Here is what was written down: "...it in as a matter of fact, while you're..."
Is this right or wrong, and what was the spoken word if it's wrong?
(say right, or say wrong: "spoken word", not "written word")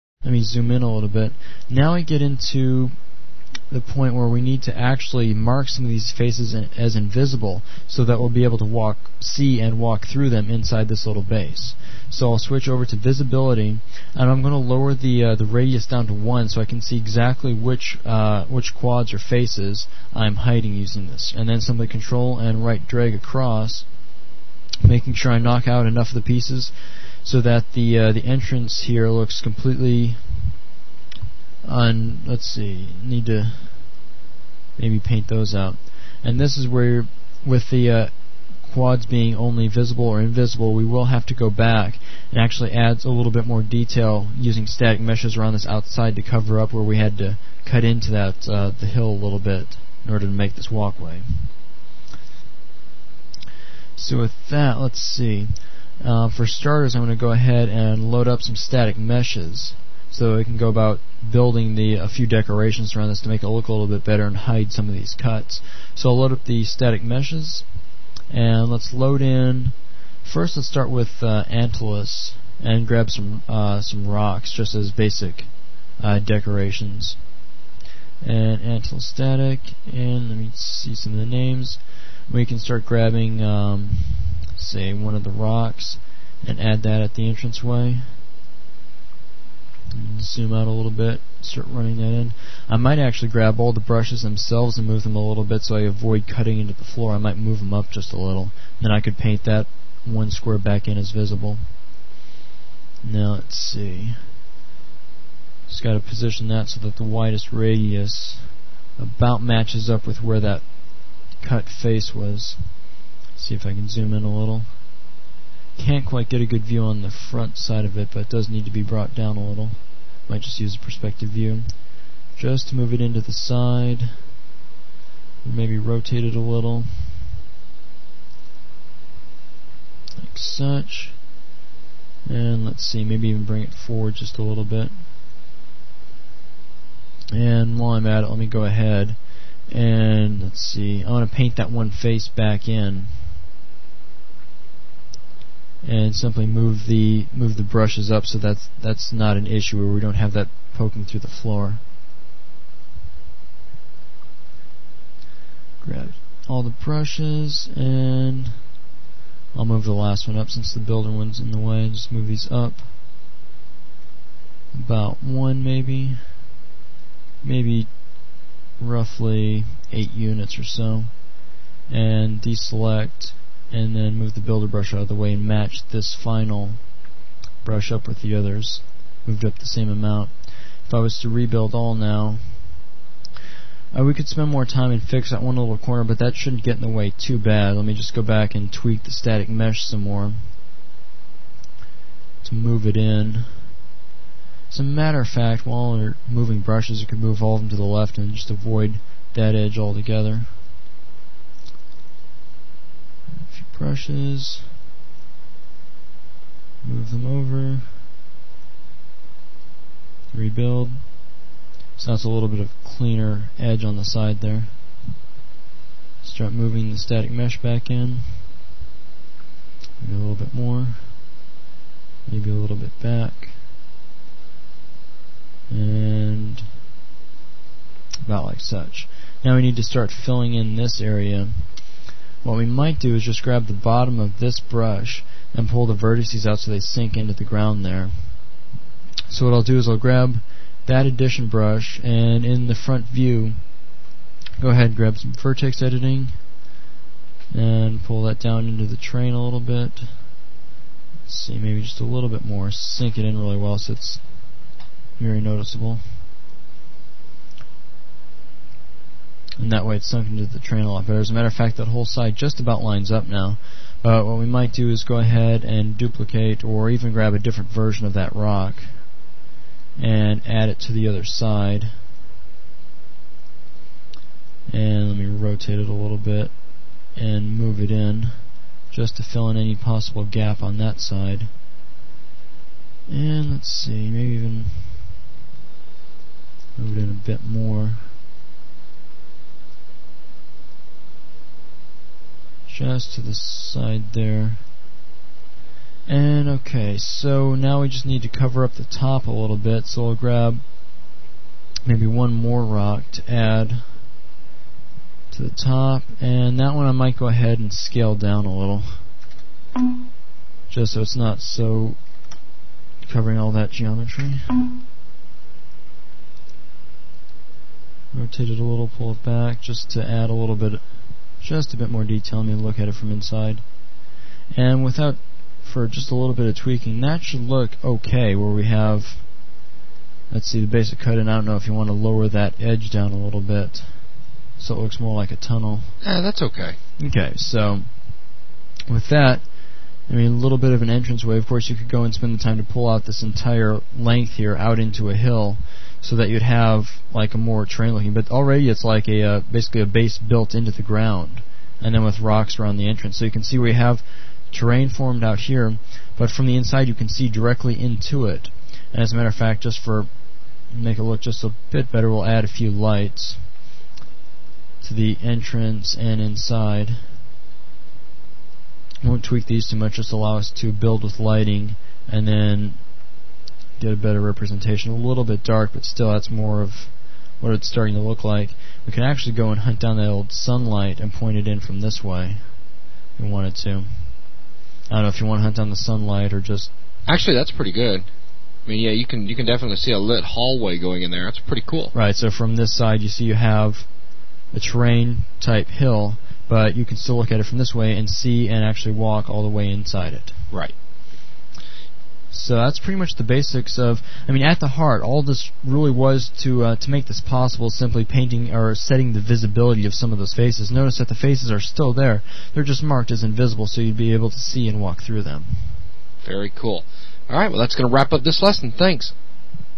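right.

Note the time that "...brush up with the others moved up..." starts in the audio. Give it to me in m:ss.
2:57.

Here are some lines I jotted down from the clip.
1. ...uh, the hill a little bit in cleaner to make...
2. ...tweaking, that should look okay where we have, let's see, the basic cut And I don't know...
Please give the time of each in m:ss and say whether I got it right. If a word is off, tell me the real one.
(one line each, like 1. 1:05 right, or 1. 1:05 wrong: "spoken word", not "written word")
1. 0:48 wrong: "order", not "cleaner"
2. 5:26 right.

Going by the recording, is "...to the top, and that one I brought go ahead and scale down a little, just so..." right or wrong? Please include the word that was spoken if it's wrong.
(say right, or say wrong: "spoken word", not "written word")
wrong: "might", not "brought".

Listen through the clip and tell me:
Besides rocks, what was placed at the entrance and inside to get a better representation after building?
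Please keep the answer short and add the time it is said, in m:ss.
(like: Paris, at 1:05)
lights, at 6:02.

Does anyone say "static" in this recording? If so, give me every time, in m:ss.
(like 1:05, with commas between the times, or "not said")
0:44, 0:58, 1:06, 1:19, 3:09, 3:36.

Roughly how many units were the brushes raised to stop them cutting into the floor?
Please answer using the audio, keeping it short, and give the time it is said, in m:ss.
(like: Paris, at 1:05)
8, at 2:49.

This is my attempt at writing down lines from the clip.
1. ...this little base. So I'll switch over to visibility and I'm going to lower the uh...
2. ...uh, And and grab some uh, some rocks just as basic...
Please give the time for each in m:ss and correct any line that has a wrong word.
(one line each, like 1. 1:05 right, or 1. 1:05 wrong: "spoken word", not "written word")
1. 0:10 right
2. 1:11 wrong: "Antalus", not "And".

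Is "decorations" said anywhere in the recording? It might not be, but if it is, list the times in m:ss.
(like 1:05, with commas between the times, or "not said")
1:02, 1:16.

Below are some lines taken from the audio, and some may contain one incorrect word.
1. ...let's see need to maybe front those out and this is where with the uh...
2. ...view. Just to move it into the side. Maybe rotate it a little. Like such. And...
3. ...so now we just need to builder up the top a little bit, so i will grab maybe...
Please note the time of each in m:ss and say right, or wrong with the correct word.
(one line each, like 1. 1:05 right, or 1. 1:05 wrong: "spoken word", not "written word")
1. 0:32 wrong: "paint", not "front"
2. 2:01 right
3. 4:56 wrong: "cover", not "builder".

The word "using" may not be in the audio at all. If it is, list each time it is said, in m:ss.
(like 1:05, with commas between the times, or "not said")
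0:20, 0:44.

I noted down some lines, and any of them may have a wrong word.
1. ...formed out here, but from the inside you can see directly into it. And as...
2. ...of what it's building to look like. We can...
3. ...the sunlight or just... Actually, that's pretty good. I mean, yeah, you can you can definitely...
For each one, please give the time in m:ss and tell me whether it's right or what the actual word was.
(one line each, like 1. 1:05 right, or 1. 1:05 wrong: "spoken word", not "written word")
1. 5:54 right
2. 6:16 wrong: "starting", not "building"
3. 6:25 right.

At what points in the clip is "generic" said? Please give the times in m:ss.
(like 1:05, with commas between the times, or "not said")
not said.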